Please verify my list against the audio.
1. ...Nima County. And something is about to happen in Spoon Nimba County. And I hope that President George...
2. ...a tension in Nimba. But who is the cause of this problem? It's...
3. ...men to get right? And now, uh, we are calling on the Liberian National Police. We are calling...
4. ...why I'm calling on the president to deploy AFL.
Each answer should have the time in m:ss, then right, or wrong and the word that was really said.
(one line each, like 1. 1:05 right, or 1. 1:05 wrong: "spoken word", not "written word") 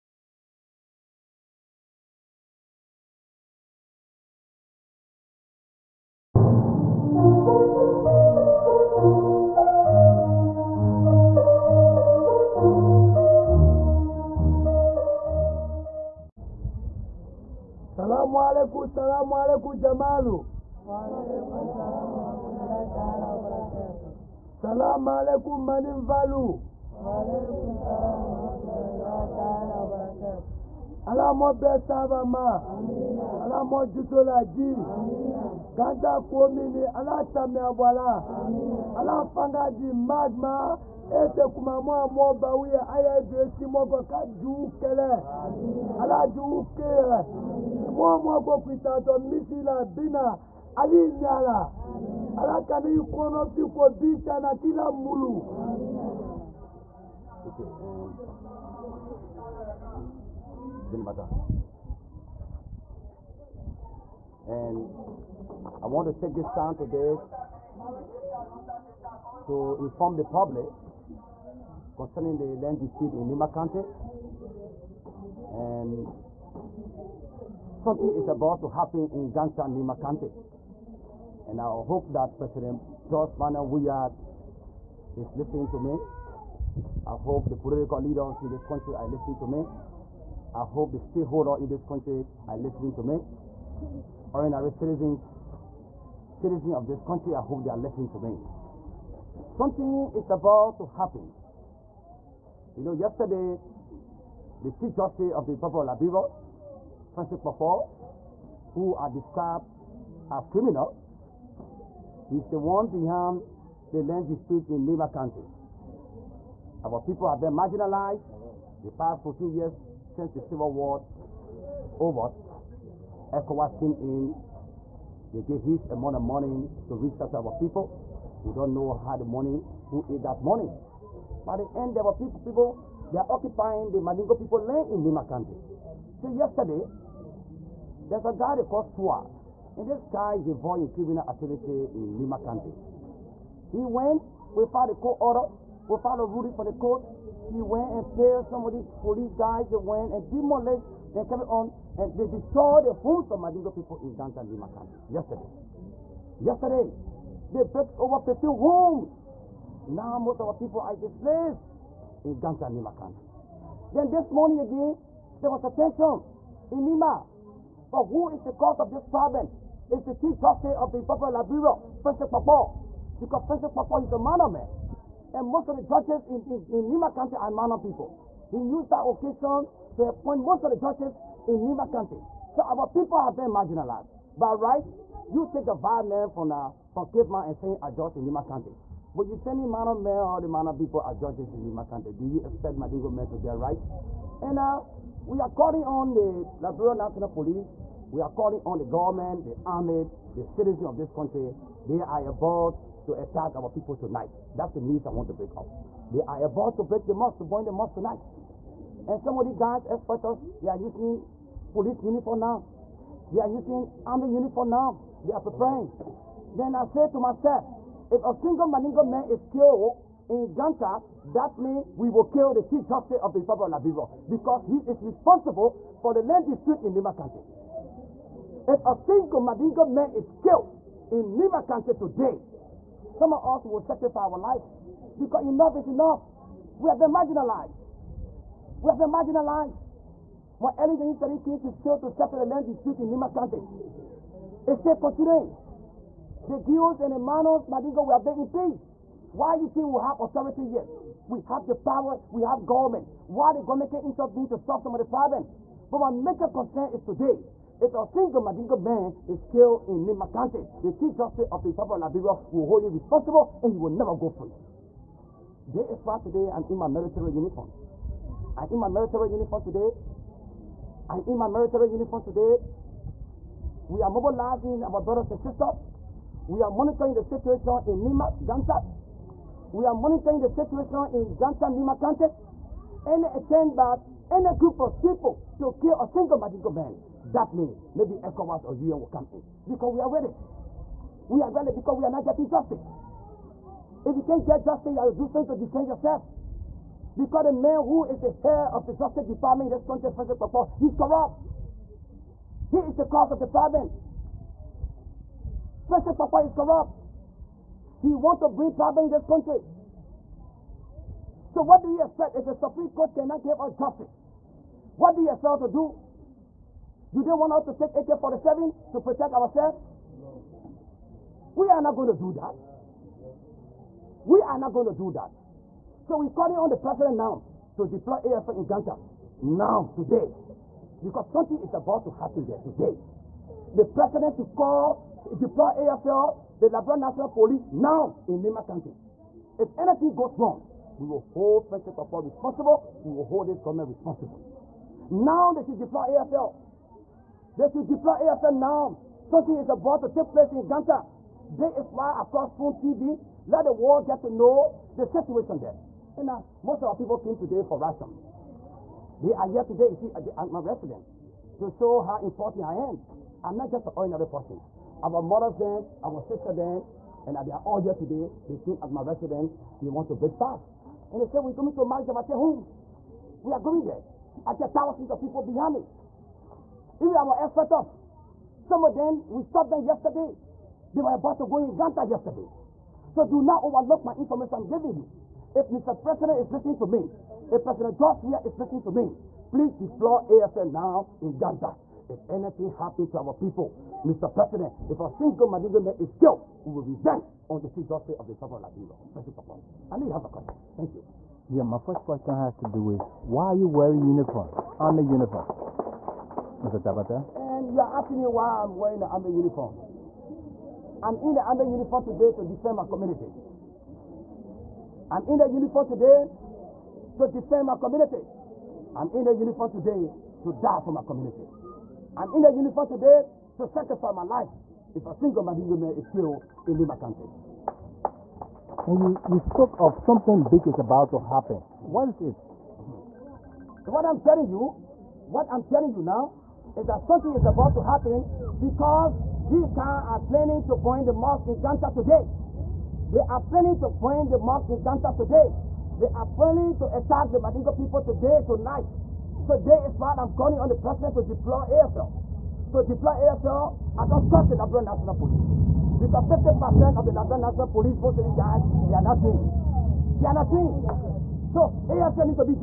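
1. 1:13 wrong: "Ganta", not "Spoon"
2. 2:45 right
3. 3:13 right
4. 7:29 right.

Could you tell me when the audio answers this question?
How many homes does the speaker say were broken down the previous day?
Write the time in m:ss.
2:37.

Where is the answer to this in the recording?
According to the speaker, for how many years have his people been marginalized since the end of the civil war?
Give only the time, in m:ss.
1:59.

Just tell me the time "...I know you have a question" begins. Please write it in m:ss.
6:39.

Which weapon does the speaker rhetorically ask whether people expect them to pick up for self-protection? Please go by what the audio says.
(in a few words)
AK-47.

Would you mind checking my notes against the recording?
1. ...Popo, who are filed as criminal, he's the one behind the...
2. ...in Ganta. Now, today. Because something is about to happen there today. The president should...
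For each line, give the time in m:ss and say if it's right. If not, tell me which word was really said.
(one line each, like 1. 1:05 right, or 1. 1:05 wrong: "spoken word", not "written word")
1. 1:47 wrong: "described", not "filed"
2. 5:28 right.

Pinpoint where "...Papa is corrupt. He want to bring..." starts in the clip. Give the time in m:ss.
5:06.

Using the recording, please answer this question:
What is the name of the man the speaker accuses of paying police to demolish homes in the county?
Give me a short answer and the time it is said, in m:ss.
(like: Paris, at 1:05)
Swa, at 2:18.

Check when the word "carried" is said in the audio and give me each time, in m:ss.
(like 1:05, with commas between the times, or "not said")
2:31.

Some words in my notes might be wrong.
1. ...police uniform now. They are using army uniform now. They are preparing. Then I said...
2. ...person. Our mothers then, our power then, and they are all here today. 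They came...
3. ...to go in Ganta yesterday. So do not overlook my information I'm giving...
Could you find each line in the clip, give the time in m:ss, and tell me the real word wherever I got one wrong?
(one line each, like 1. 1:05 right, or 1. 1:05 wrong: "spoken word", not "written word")
1. 3:31 right
2. 6:04 wrong: "sister", not "power"
3. 6:21 right.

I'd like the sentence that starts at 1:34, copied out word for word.
Ordinary citizens, citizens of this country, I hope they are listening to me.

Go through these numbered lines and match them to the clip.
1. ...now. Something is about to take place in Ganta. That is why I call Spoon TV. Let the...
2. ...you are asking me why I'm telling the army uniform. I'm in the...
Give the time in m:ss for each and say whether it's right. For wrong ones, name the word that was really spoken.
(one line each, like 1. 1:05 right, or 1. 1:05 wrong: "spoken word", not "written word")
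1. 5:48 right
2. 6:47 wrong: "wearing", not "telling".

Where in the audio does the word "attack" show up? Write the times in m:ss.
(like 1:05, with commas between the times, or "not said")
3:23, 7:26.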